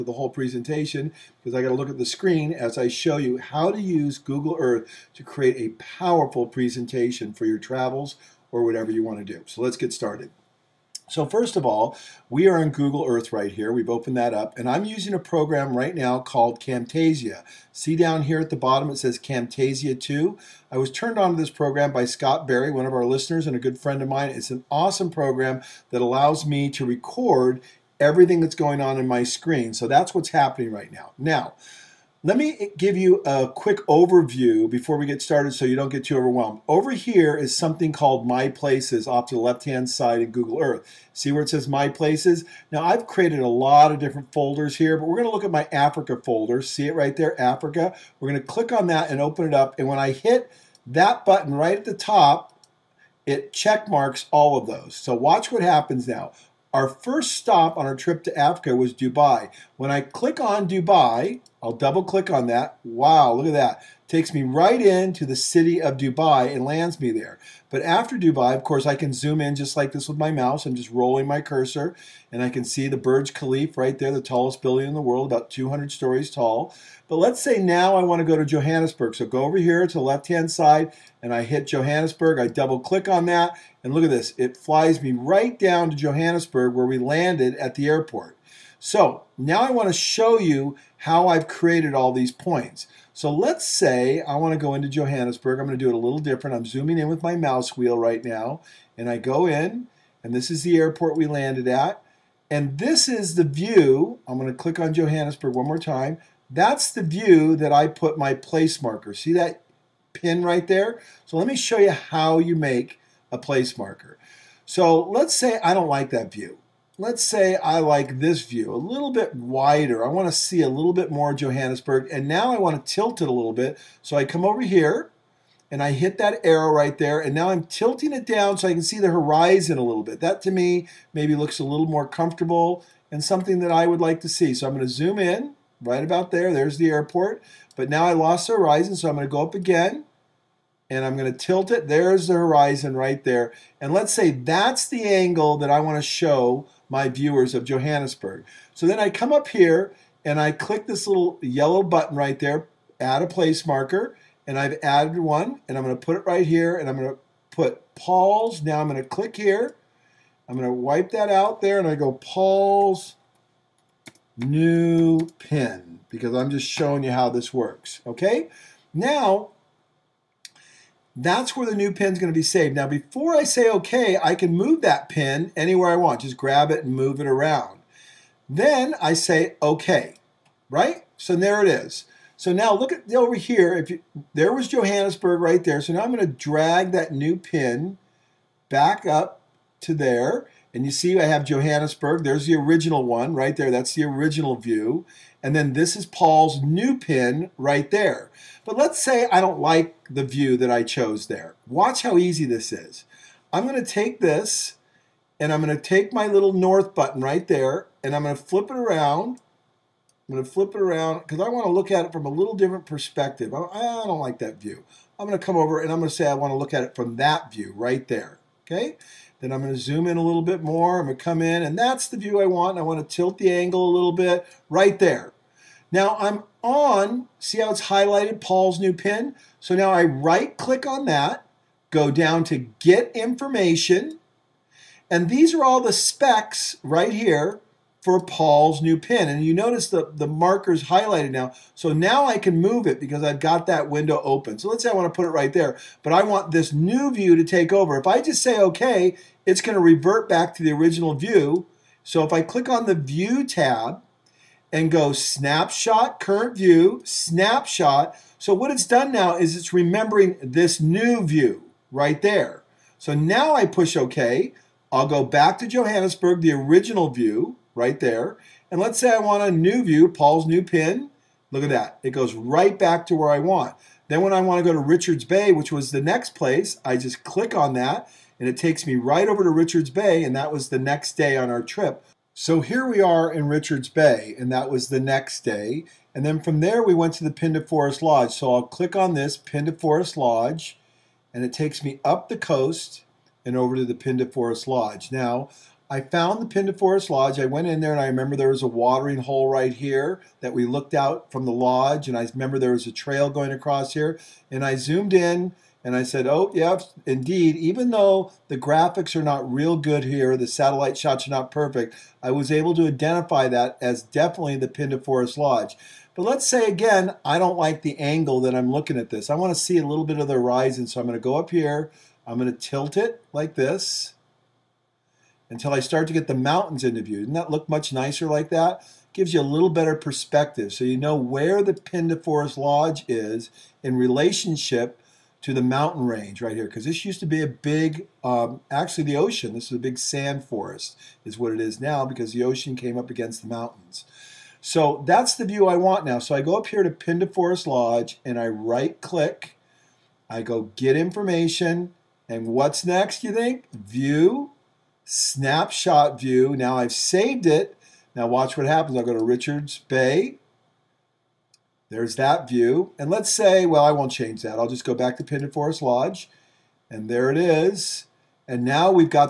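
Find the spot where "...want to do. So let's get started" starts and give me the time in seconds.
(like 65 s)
9 s.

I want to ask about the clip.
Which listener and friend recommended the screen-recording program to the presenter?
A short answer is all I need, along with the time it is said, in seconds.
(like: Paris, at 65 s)
Scott Barry, at 22 s.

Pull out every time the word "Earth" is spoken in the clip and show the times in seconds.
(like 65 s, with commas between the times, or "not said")
4 s, 13 s, 40 s.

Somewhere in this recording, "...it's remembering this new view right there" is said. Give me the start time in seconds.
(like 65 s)
259 s.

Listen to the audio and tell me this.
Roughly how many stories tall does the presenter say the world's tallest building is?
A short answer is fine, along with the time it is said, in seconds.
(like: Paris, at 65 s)
200, at 75 s.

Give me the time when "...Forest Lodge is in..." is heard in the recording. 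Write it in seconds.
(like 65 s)
332 s.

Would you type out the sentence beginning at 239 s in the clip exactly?
And you notice the, the marker's highlighted now.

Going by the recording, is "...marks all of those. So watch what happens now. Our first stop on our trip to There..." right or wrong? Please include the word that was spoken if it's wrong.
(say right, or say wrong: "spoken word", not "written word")
wrong: "Africa", not "There".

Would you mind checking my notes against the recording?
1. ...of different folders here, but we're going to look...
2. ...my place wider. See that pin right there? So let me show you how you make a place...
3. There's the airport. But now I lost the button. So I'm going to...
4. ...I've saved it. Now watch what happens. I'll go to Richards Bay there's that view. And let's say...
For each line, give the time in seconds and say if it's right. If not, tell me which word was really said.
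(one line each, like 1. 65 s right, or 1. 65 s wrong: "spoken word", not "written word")
1. 43 s right
2. 108 s wrong: "marker", not "wider"
3. 136 s wrong: "horizon", not "button"
4. 356 s right.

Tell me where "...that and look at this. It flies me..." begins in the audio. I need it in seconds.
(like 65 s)
83 s.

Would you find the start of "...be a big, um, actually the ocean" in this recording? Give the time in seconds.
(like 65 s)
337 s.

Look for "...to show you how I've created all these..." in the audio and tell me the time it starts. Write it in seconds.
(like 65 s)
89 s.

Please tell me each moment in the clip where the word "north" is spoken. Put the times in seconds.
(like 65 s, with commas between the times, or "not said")
206 s.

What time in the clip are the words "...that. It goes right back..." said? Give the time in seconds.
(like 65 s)
271 s.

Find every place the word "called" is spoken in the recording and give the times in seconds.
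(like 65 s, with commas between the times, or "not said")
16 s, 37 s.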